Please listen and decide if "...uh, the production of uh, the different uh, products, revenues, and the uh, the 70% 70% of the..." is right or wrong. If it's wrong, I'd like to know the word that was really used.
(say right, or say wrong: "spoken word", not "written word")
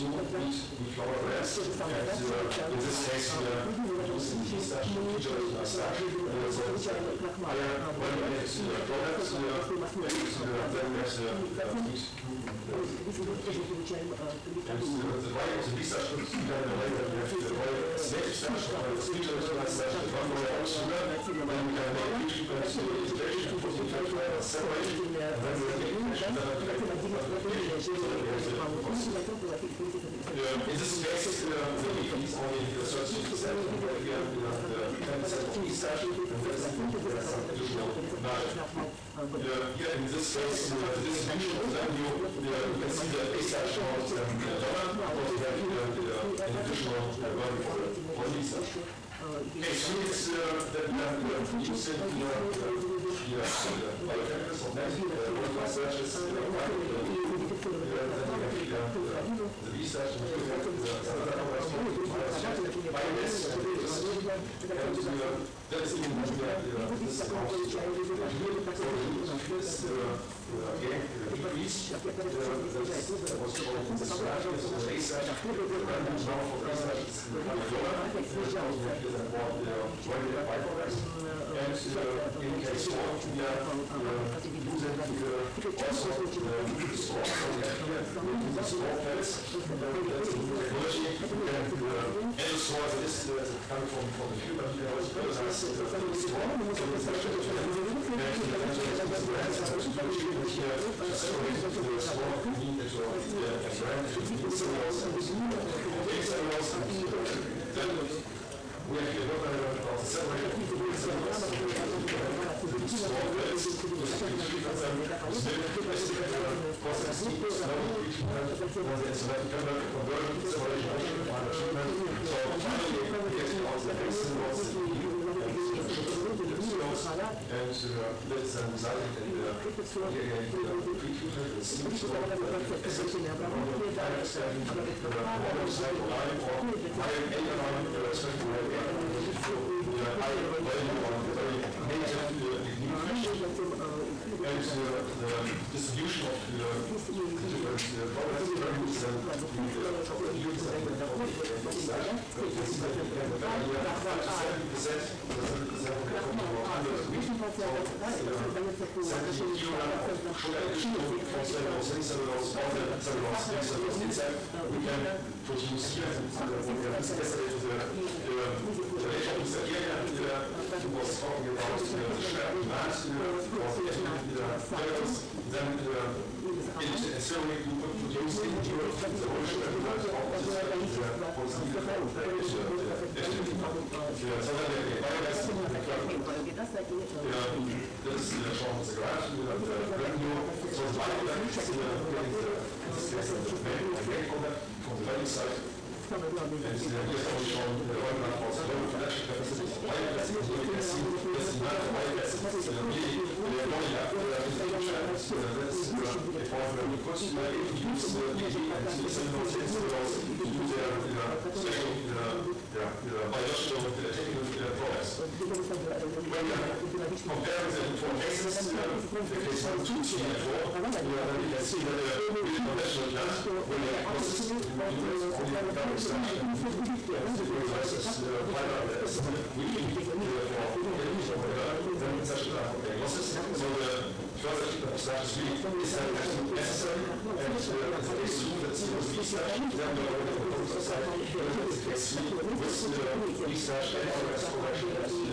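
wrong: "distribution", not "production".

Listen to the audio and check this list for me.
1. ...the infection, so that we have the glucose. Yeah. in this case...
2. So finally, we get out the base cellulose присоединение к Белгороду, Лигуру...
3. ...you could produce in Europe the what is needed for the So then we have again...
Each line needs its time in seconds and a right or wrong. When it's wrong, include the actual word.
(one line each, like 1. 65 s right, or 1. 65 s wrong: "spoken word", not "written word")
1. 26 s right
2. 122 s right
3. 177 s right.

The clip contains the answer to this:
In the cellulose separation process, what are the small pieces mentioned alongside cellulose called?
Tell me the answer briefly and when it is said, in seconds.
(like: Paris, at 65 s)
Pellets, at 112 s.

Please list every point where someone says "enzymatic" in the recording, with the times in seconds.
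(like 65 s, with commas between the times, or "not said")
119 s.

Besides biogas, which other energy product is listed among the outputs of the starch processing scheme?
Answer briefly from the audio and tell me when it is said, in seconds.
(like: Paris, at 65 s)
Electricity, at 63 s.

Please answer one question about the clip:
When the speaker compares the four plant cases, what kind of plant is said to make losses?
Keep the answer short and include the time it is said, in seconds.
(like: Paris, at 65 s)
Conventional plant, at 222 s.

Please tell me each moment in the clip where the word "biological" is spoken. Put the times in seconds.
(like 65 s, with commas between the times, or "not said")
213 s.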